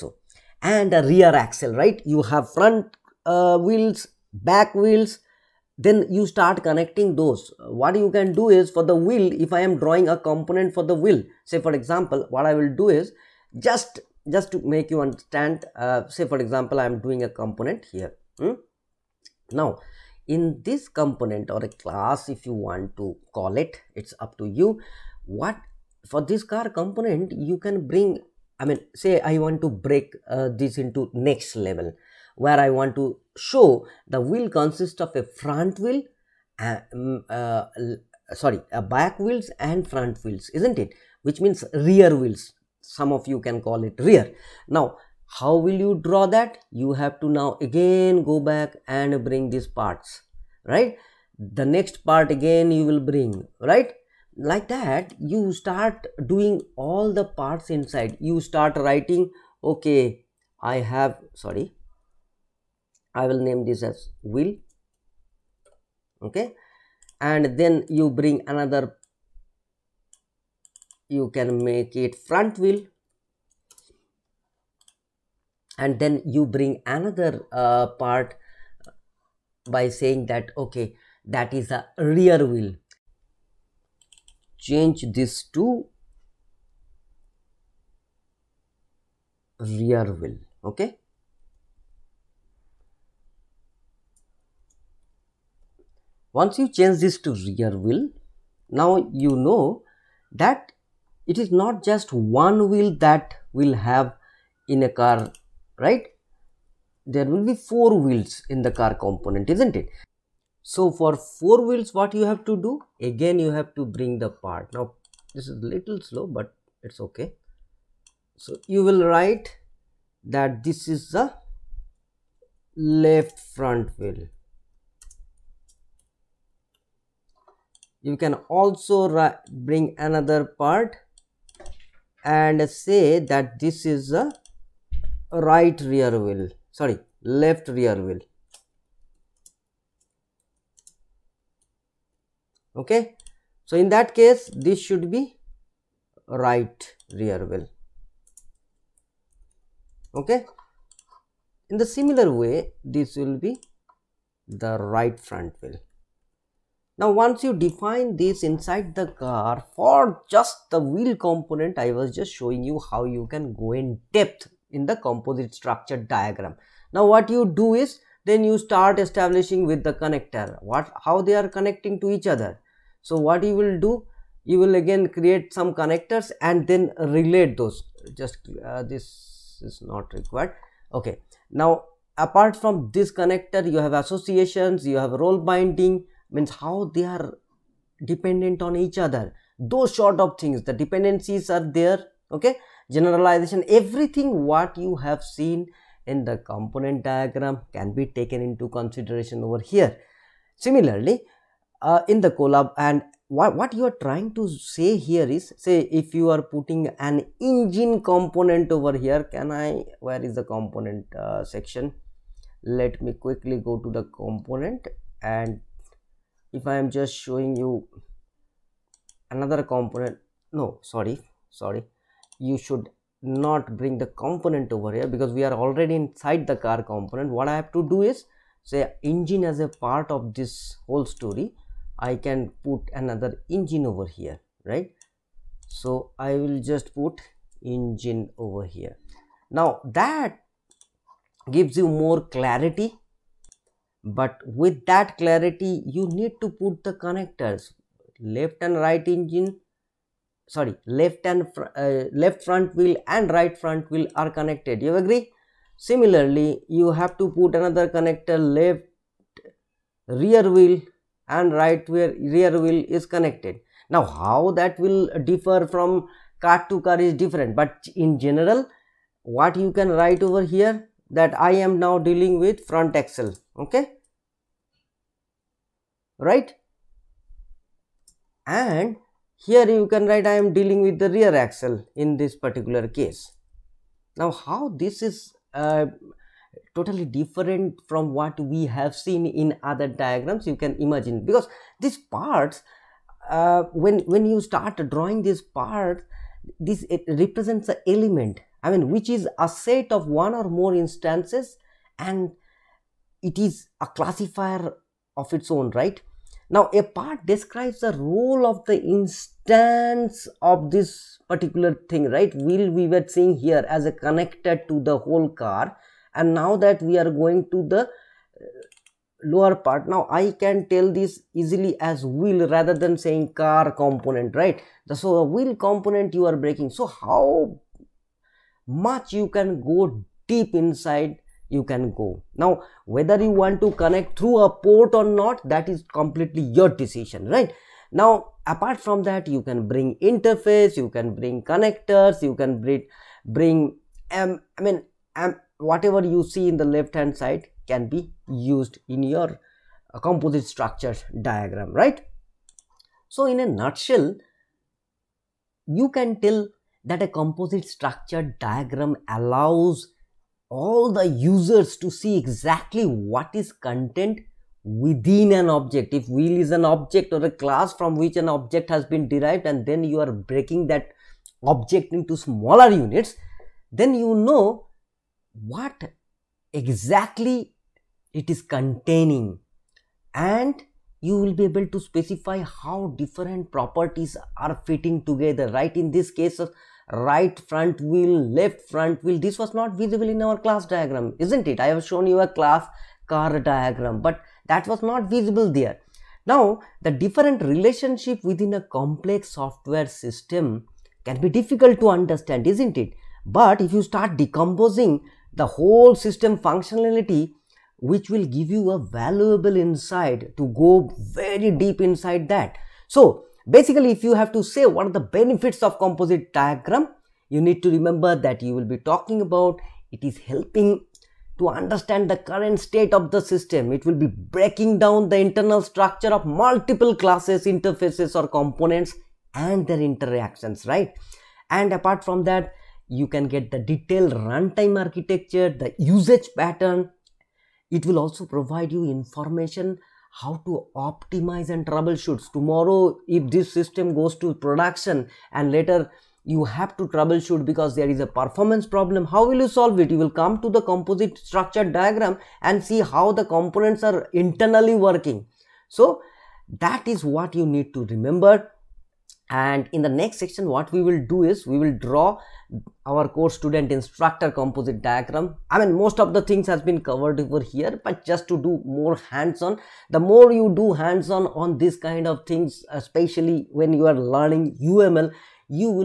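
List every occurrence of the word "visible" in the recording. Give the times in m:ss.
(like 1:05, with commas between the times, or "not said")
6:29, 6:35.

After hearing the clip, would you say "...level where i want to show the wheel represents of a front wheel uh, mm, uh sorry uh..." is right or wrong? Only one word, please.
wrong.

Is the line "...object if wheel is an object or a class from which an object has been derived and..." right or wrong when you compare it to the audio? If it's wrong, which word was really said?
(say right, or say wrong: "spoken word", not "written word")
right.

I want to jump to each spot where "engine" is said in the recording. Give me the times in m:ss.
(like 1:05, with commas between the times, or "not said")
3:27, 3:49, 3:53, 3:57, 4:09.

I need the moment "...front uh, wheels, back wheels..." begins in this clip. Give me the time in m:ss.
0:02.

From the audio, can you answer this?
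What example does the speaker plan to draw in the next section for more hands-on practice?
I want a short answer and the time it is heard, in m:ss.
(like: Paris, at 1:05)
Course student instructor, at 7:43.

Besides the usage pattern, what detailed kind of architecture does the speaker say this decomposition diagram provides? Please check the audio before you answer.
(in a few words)
Runtime architecture.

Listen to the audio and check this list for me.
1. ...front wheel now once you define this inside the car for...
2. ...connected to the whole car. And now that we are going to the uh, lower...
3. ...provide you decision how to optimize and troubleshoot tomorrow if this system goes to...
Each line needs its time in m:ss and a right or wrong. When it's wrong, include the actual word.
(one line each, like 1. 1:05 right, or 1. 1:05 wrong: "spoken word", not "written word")
1. 2:35 right
2. 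5:13 right
3. 7:18 wrong: "information", not "decision".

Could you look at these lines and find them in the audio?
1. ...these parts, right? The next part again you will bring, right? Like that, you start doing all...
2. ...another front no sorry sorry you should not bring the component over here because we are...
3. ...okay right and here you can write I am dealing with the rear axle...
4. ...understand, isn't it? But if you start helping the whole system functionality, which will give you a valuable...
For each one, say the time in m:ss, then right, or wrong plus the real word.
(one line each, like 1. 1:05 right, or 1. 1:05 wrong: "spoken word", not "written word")
1. 0:49 right
2. 3:39 wrong: "component", not "front"
3. 4:33 right
4. 6:41 wrong: "decomposing", not "helping".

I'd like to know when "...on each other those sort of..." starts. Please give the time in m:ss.
3:08.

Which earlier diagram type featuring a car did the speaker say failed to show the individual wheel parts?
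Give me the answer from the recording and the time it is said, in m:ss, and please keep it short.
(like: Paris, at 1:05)
Class diagram, at 6:30.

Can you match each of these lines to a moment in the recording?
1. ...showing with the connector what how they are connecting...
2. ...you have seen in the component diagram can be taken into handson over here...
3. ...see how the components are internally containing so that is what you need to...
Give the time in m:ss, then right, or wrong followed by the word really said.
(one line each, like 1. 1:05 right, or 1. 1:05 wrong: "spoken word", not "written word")
1. 2:48 wrong: "establishing", not "showing"
2. 3:14 wrong: "consideration", not "handson"
3. 7:32 wrong: "working", not "containing".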